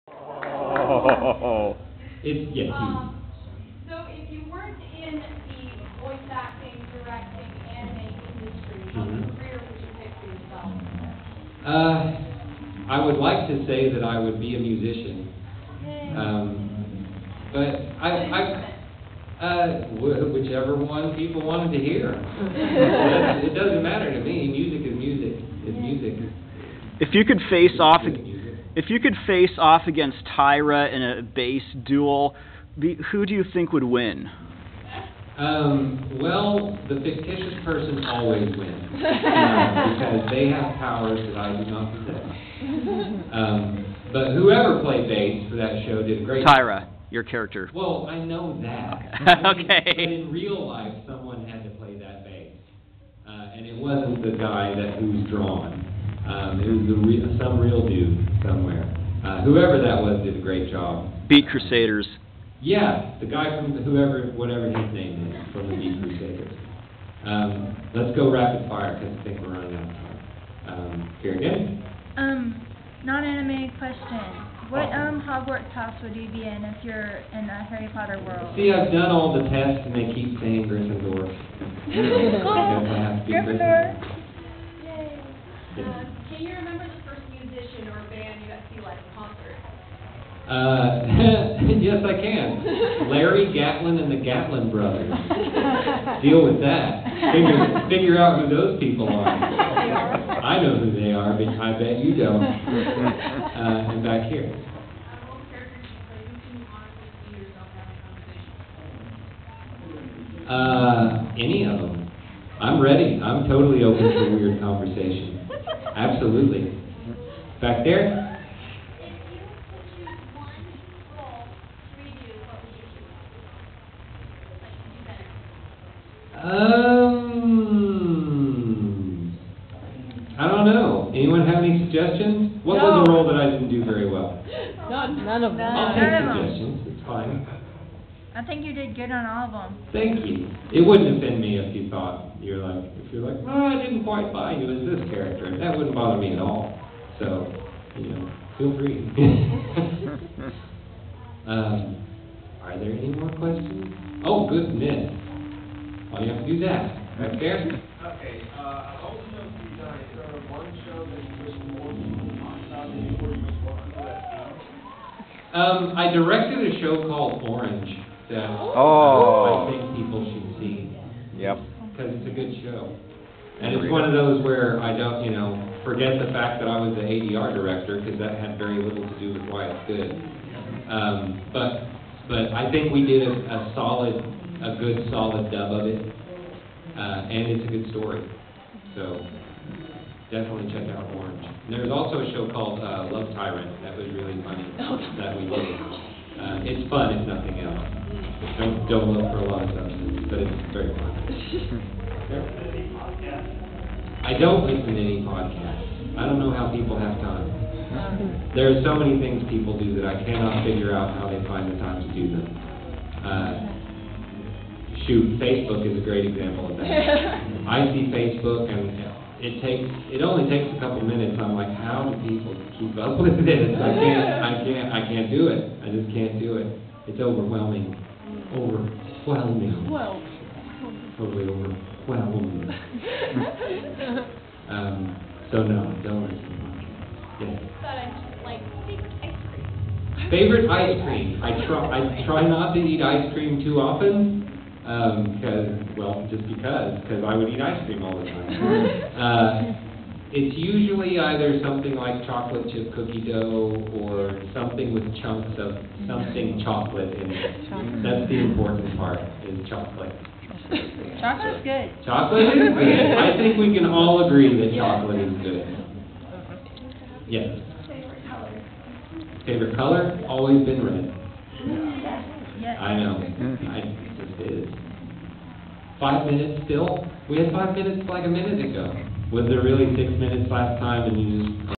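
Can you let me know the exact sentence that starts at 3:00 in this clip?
Um, but but I think we did a, a solid, a good solid dub of it, uh, and it's a good story.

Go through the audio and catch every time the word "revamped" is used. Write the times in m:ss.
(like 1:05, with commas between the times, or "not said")
not said.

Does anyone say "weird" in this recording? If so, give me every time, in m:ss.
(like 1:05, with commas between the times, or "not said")
1:54.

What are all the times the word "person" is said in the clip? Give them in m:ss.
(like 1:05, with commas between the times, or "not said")
0:37.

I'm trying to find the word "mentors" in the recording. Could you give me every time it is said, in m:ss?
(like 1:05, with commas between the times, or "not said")
not said.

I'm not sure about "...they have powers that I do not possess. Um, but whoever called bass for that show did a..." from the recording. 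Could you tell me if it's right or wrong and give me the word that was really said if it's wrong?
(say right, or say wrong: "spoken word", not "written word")
wrong: "played", not "called".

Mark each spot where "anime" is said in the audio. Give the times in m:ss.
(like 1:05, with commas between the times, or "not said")
0:07, 1:13.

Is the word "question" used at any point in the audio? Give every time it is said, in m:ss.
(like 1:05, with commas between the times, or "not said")
1:13, 2:33.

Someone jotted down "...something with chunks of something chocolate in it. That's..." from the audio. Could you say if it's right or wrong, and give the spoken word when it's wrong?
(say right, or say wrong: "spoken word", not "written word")
right.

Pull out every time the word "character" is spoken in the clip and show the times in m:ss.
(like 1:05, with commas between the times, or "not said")
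0:47, 2:25.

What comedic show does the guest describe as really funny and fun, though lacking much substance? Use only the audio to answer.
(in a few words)
Love Tyrant.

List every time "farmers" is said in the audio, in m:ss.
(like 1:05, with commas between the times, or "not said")
not said.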